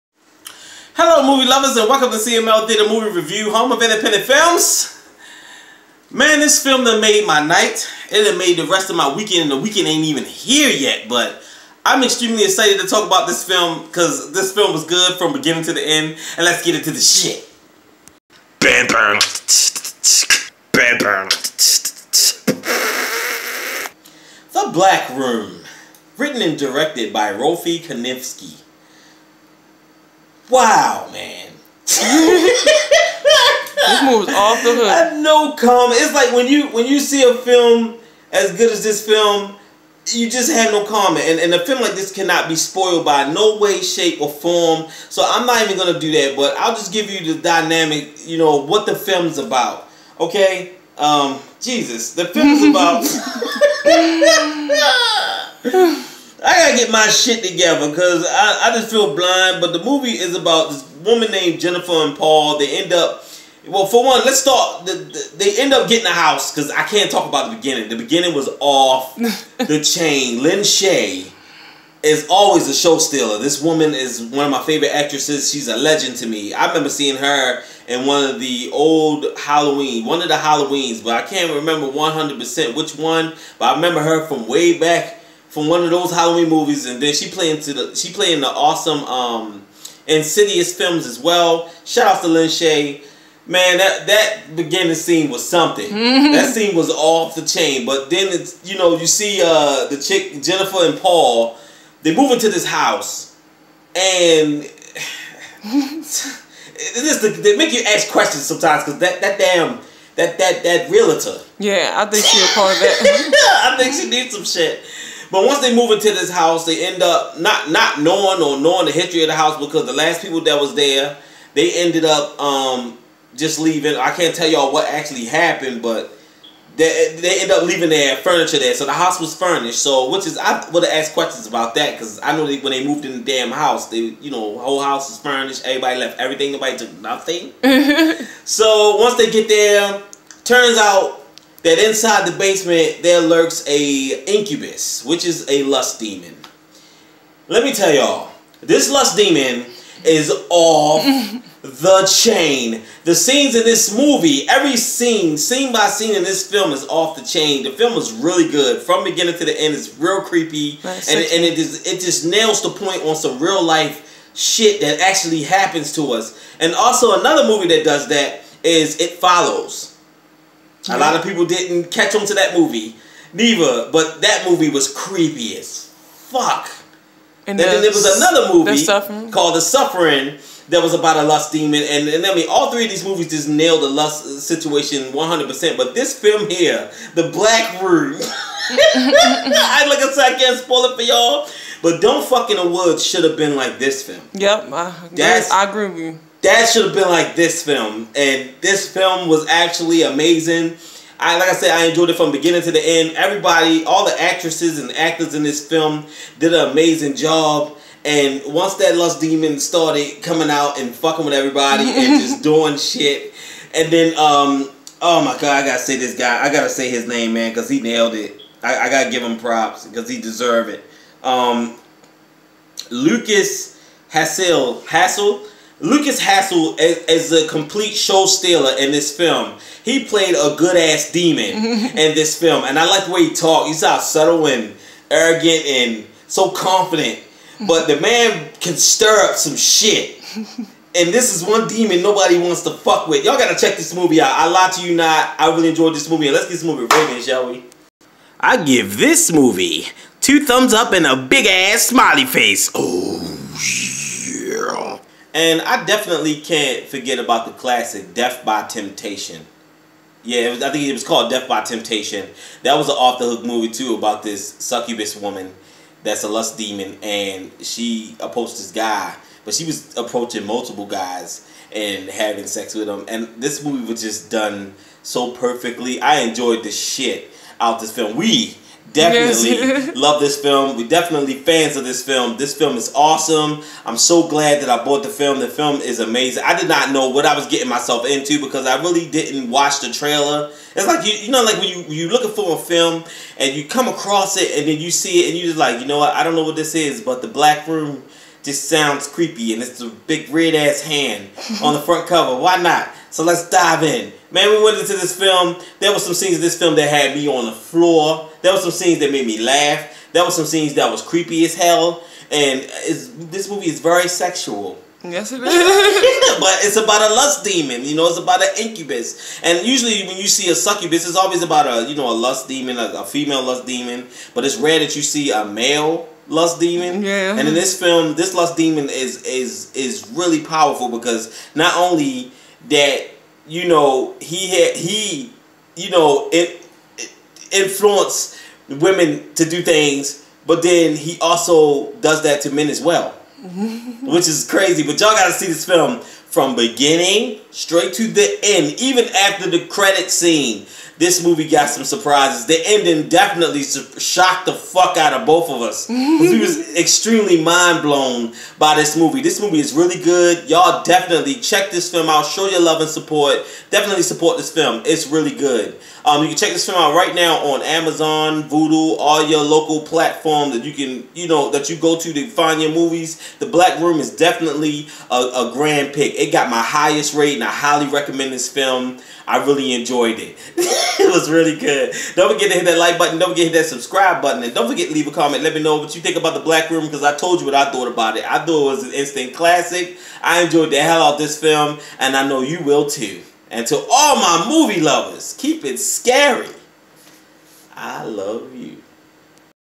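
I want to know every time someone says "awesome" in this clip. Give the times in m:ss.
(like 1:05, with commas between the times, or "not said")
1:28, 4:42.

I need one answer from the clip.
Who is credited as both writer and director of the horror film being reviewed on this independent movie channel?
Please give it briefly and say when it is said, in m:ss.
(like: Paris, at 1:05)
Rolfie Kanefsky, at 0:27.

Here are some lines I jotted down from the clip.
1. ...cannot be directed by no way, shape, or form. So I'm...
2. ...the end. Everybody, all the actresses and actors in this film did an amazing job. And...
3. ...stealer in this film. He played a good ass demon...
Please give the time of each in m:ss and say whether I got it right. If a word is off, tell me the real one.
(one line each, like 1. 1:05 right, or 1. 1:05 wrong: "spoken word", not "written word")
1. 0:42 wrong: "spoiled", not "directed"
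2. 3:22 right
3. 3:48 right.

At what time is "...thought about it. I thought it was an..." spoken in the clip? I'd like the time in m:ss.
6:27.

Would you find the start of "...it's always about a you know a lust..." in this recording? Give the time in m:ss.
5:21.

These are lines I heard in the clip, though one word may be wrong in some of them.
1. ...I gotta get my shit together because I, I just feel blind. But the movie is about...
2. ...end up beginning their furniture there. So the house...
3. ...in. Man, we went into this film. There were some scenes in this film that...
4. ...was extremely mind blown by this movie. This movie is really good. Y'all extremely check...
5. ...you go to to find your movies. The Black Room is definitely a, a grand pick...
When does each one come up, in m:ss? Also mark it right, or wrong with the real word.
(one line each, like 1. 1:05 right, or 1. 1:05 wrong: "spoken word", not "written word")
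1. 0:56 right
2. 2:07 wrong: "leaving", not "beginning"
3. 5:03 right
4. 5:56 wrong: "definitely", not "extremely"
5. 6:11 right.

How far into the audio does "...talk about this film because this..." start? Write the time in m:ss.
0:12.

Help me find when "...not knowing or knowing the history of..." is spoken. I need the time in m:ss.
1:57.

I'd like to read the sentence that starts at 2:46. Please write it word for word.
And also another movie that does that is It Follows.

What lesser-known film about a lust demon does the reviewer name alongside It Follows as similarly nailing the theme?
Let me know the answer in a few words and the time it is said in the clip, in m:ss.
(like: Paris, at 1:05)
The Suffering, at 2:59.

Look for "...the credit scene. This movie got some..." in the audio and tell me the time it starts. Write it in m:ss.
5:49.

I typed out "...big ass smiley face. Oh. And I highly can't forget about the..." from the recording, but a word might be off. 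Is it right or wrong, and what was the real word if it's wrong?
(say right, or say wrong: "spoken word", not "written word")
wrong: "definitely", not "highly".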